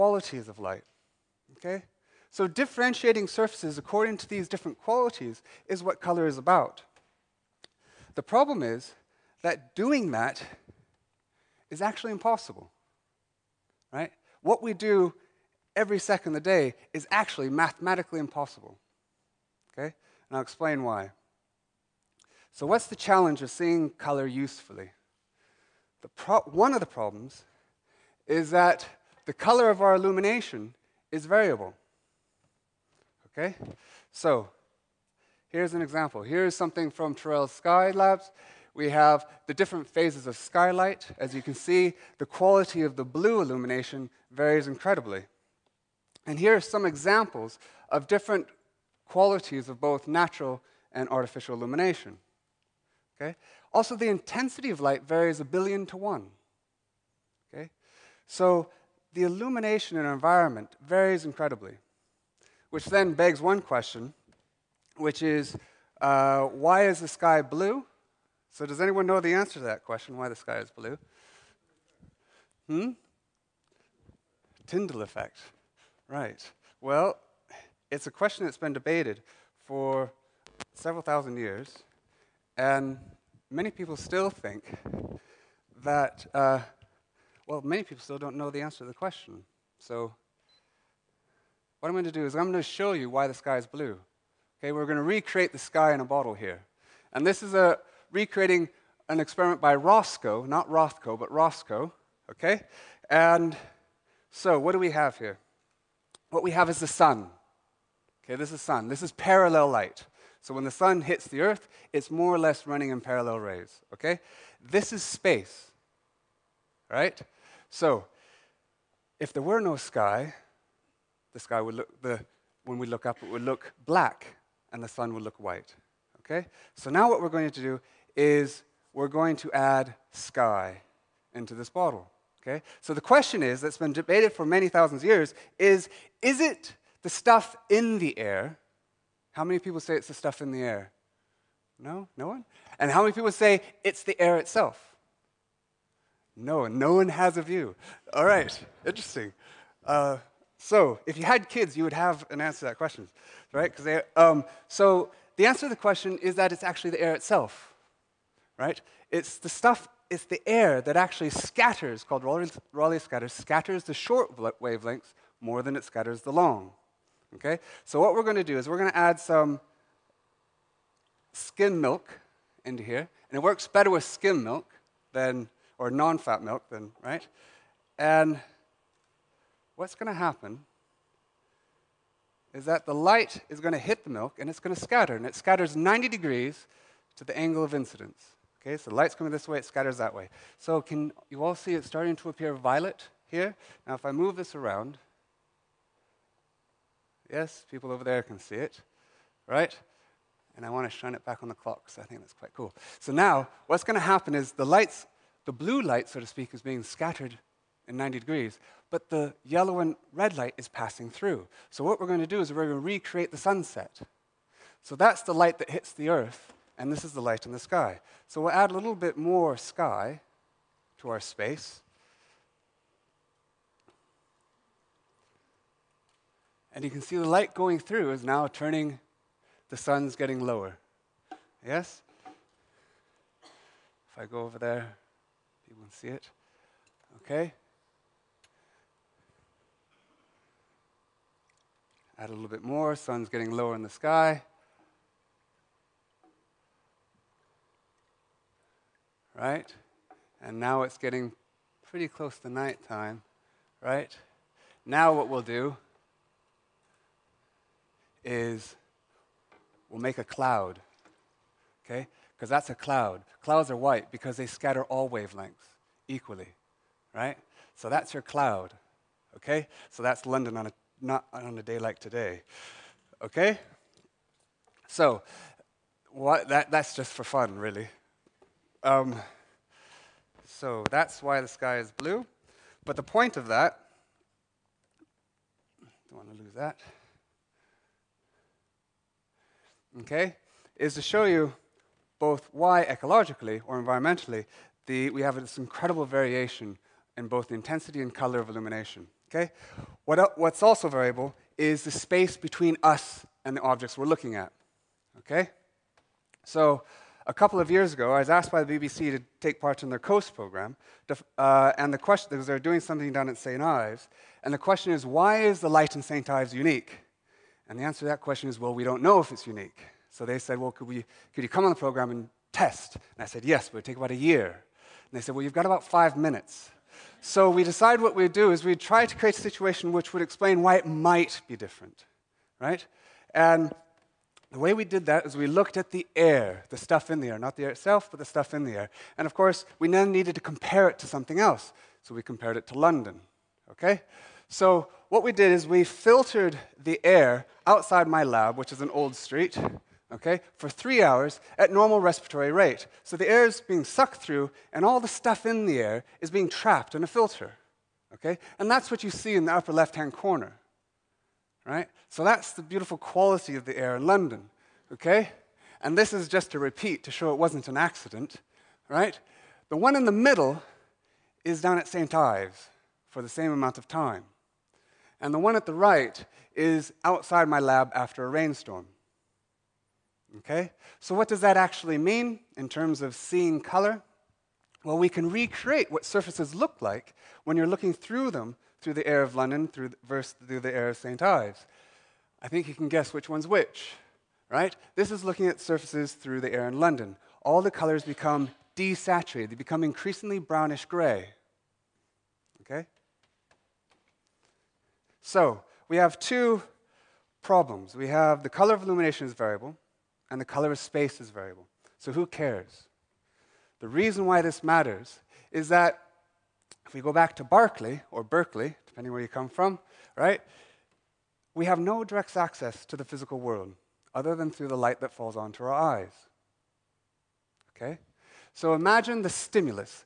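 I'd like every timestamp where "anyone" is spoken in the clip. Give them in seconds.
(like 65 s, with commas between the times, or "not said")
68 s.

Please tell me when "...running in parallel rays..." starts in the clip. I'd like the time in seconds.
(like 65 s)
112 s.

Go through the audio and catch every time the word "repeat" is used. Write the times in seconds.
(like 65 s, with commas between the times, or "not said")
366 s.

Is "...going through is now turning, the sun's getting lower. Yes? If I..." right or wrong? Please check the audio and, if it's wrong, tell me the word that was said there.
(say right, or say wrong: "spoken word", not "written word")
right.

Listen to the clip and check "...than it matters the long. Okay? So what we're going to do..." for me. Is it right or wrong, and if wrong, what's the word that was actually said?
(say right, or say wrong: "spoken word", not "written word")
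wrong: "scatters", not "matters".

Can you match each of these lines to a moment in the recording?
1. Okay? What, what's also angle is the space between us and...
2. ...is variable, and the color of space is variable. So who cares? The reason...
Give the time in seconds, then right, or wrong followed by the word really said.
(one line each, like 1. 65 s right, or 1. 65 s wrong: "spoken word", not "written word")
1. 299 s wrong: "variable", not "angle"
2. 409 s right.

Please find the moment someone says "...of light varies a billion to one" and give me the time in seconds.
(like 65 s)
54 s.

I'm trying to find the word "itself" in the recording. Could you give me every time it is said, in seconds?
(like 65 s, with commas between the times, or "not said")
144 s, 157 s, 337 s.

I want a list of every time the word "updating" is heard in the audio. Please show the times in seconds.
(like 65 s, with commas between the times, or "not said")
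not said.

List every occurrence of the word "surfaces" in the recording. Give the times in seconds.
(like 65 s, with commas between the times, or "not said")
3 s, 386 s, 395 s.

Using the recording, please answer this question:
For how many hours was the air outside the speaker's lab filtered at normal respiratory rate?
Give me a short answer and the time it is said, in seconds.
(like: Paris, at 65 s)
3, at 350 s.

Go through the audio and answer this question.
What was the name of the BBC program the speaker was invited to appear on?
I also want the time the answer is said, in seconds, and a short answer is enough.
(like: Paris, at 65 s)
COAST, at 309 s.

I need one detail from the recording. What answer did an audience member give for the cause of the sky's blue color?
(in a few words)
Tyndall effect.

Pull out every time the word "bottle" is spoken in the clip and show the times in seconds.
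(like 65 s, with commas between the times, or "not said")
96 s, 131 s.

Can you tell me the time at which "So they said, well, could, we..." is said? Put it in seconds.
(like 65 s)
320 s.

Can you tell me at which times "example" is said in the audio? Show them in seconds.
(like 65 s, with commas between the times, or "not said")
35 s, 46 s.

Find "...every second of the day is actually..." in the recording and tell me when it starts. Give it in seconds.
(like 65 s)
15 s.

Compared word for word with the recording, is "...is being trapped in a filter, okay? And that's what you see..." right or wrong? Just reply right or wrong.
right.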